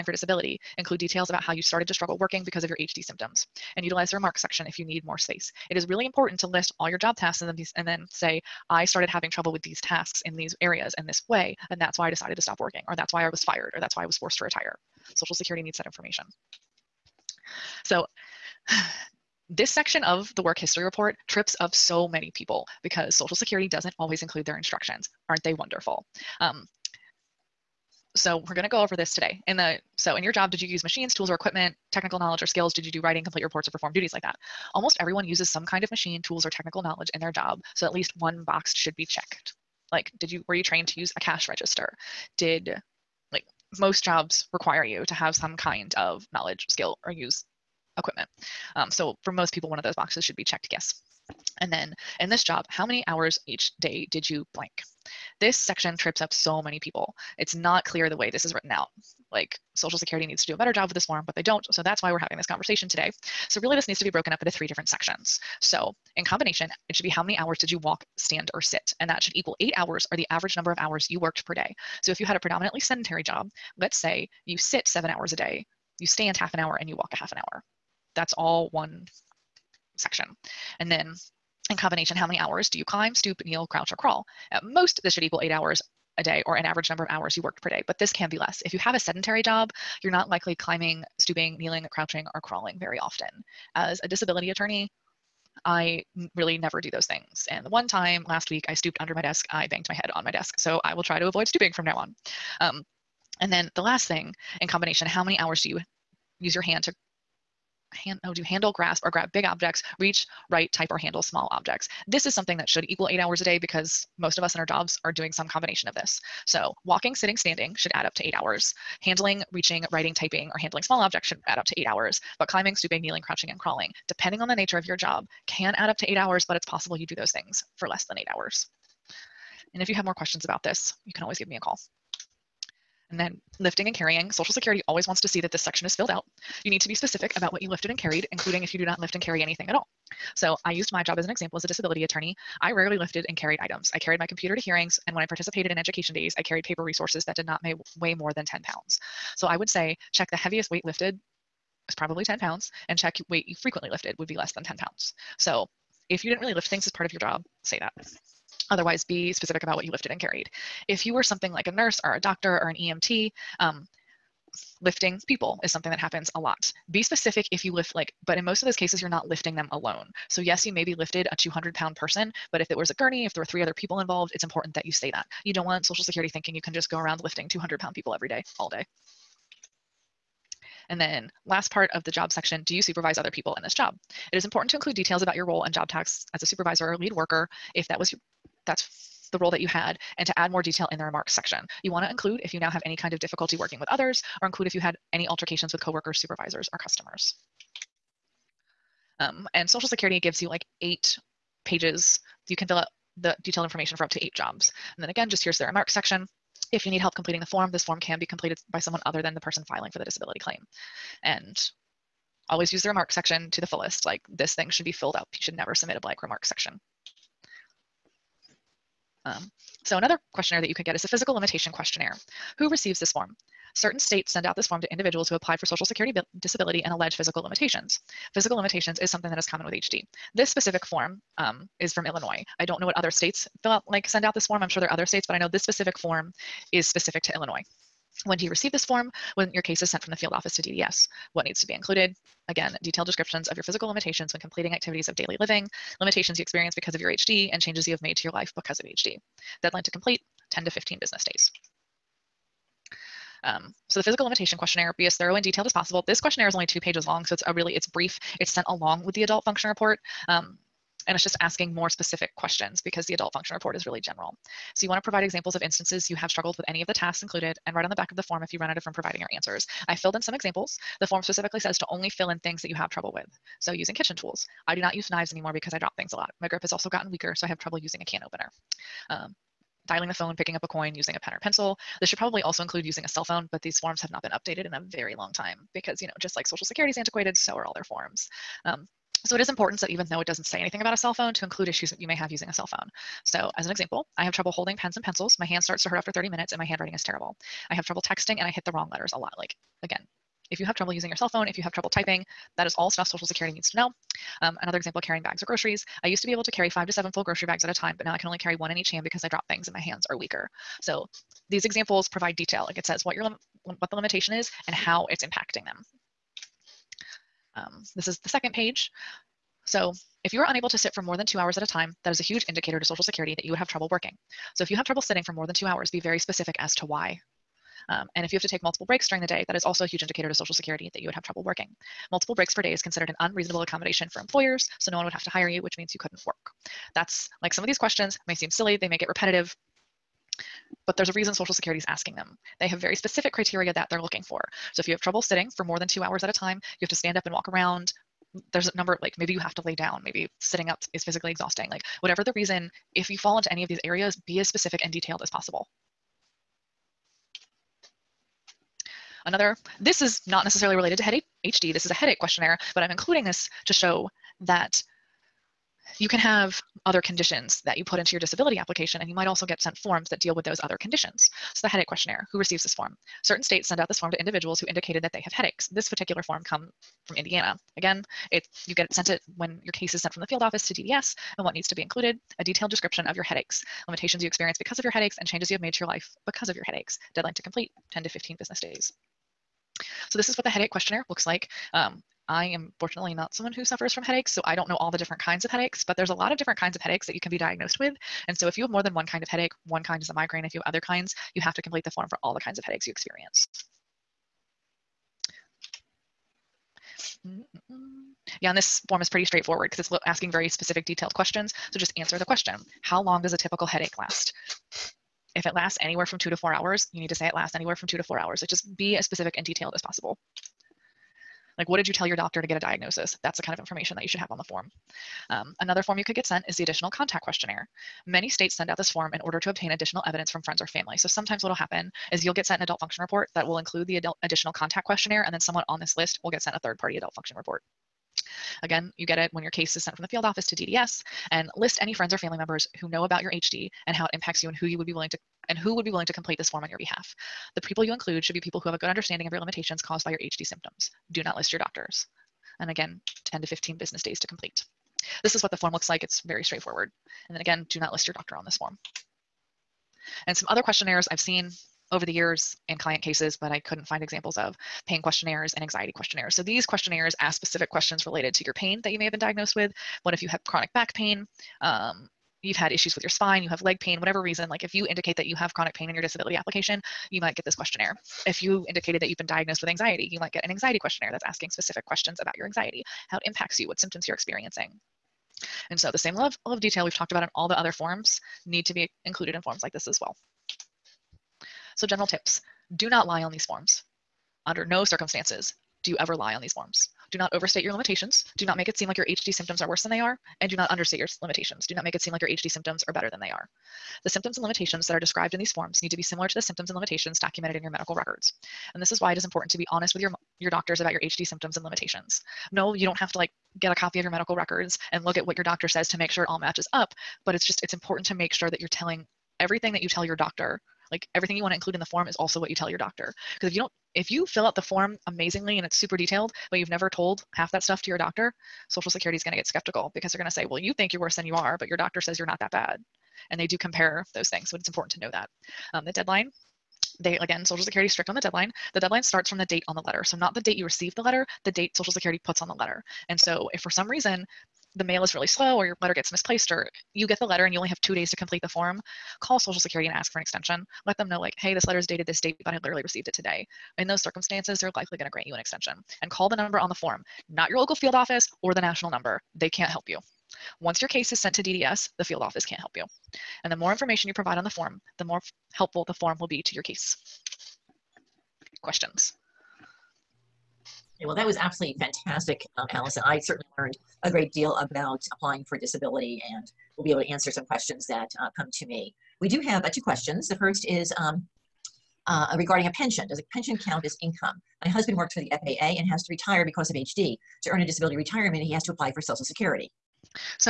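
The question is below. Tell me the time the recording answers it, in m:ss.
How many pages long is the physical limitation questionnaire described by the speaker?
4:16.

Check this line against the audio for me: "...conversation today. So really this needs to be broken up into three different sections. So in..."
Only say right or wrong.
right.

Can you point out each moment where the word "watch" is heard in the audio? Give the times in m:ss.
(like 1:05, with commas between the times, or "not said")
not said.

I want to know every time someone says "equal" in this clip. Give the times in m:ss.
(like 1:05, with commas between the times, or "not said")
1:09, 1:25, 1:52.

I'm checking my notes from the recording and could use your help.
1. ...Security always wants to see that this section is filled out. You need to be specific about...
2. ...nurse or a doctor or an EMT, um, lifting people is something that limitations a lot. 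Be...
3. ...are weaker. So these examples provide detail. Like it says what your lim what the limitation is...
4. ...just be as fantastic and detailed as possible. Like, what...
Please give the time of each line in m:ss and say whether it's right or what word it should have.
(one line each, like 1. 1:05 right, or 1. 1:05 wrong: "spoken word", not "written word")
1. 2:14 right
2. 2:41 wrong: "happens", not "limitations"
3. 5:10 right
4. 6:58 wrong: "specific", not "fantastic".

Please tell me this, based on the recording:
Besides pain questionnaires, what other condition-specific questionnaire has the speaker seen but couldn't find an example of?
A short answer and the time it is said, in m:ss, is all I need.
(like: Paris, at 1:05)
anxiety questionnaires, at 7:45.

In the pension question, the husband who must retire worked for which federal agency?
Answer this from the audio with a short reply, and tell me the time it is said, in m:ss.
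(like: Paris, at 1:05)
FAA, at 9:44.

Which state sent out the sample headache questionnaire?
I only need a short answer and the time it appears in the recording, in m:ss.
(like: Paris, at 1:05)
Indiana, at 6:15.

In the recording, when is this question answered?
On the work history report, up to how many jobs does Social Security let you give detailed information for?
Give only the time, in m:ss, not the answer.
3:24.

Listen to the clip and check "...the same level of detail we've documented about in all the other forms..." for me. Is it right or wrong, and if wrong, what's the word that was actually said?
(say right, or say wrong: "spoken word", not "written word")
wrong: "talked", not "documented".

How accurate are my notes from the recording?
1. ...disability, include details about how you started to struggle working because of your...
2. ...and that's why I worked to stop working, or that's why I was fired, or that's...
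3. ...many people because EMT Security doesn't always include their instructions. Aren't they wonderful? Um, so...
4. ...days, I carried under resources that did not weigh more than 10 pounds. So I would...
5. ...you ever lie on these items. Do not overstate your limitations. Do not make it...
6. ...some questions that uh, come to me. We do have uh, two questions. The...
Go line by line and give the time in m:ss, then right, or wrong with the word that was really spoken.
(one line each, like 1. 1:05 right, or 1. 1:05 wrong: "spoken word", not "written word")
1. 0:00 right
2. 0:11 wrong: "decided", not "worked"
3. 0:22 wrong: "Social", not "EMT"
4. 2:26 wrong: "paper", not "under"
5. 8:15 wrong: "forms", not "items"
6. 9:37 right.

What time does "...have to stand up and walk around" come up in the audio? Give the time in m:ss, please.
5:46.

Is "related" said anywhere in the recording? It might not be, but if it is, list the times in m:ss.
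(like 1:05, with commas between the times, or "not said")
6:00, 7:48.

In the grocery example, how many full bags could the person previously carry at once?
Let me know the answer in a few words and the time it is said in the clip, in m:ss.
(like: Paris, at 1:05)
5 to 7, at 5:06.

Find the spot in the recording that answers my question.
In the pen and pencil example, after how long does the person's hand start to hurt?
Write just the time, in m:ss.
4:55.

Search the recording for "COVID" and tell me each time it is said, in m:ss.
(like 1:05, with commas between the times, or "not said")
not said.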